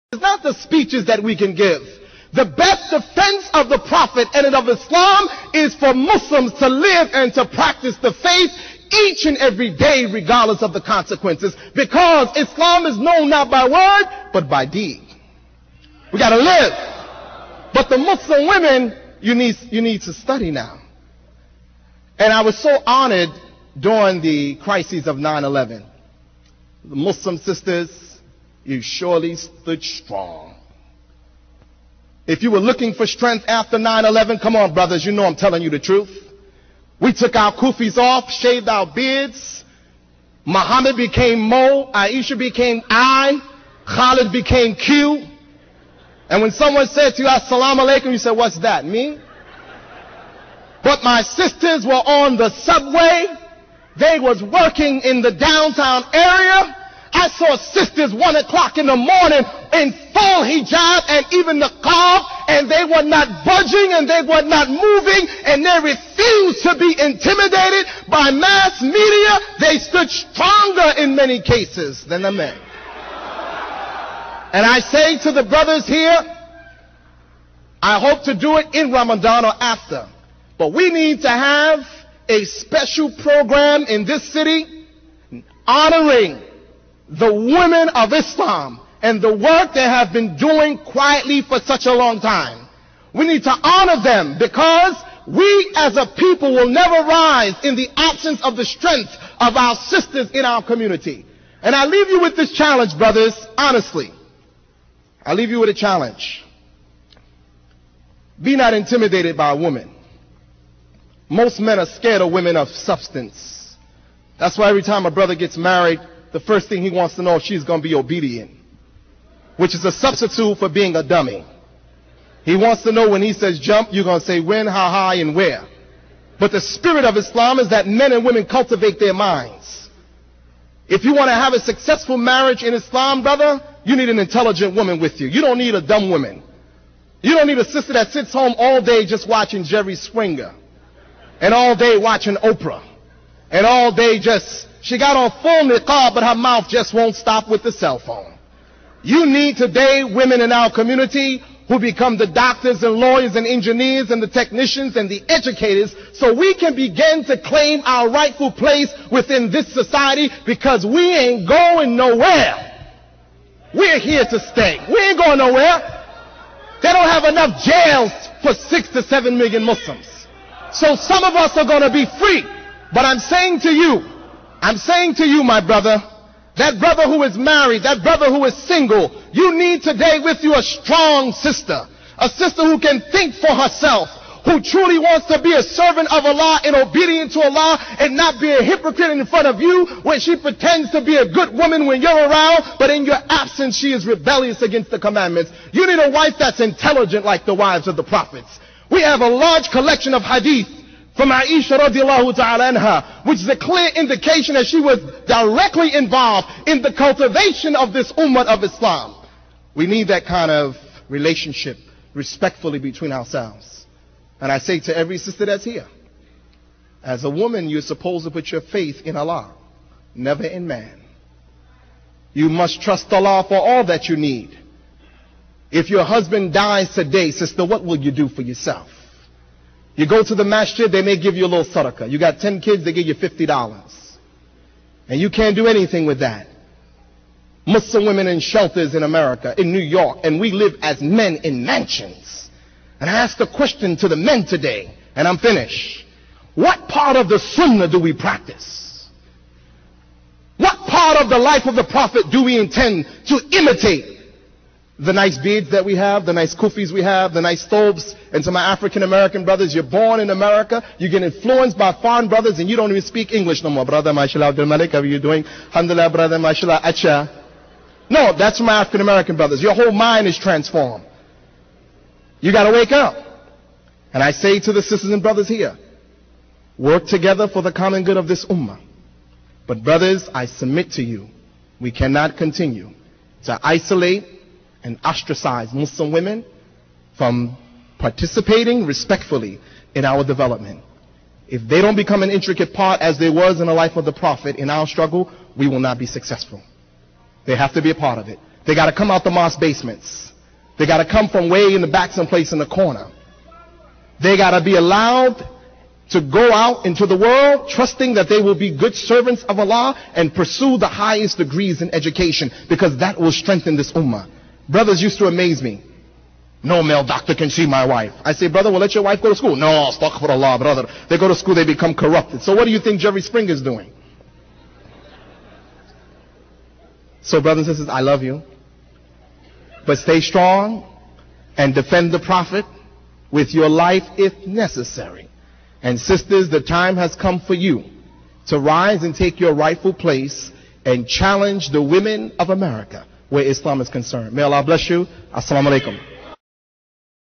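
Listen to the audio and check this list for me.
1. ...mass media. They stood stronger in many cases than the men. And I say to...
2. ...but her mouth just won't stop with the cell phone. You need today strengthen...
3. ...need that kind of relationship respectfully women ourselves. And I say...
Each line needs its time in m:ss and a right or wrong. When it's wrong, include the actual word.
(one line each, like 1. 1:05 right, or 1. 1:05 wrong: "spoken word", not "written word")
1. 1:08 right
2. 2:26 wrong: "women", not "strengthen"
3. 3:29 wrong: "between", not "women".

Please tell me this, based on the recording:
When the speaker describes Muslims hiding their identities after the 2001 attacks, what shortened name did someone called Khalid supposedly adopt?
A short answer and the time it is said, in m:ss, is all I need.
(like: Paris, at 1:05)
Q, at 0:44.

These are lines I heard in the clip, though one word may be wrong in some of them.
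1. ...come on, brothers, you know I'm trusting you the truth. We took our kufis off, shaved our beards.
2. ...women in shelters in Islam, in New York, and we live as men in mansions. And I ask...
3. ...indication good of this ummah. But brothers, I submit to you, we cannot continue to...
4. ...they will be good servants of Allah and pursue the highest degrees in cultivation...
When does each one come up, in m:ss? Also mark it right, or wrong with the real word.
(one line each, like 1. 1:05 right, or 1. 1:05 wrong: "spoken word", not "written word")
1. 0:34 wrong: "telling", not "trusting"
2. 3:58 wrong: "America", not "Islam"
3. 4:37 wrong: "common", not "indication"
4. 5:08 wrong: "education", not "cultivation".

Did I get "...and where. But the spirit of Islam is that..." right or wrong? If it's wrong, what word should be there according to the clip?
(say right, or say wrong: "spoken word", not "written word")
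right.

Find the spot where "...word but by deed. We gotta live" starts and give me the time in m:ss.
0:13.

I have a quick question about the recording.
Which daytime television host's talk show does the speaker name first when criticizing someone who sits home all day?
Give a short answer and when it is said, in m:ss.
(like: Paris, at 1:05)
Jerry Springer, at 2:19.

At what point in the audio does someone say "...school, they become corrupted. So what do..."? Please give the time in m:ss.
5:21.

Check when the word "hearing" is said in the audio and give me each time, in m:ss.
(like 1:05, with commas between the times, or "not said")
not said.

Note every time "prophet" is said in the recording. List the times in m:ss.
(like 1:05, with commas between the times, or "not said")
0:03, 3:18, 4:11, 4:54, 5:32.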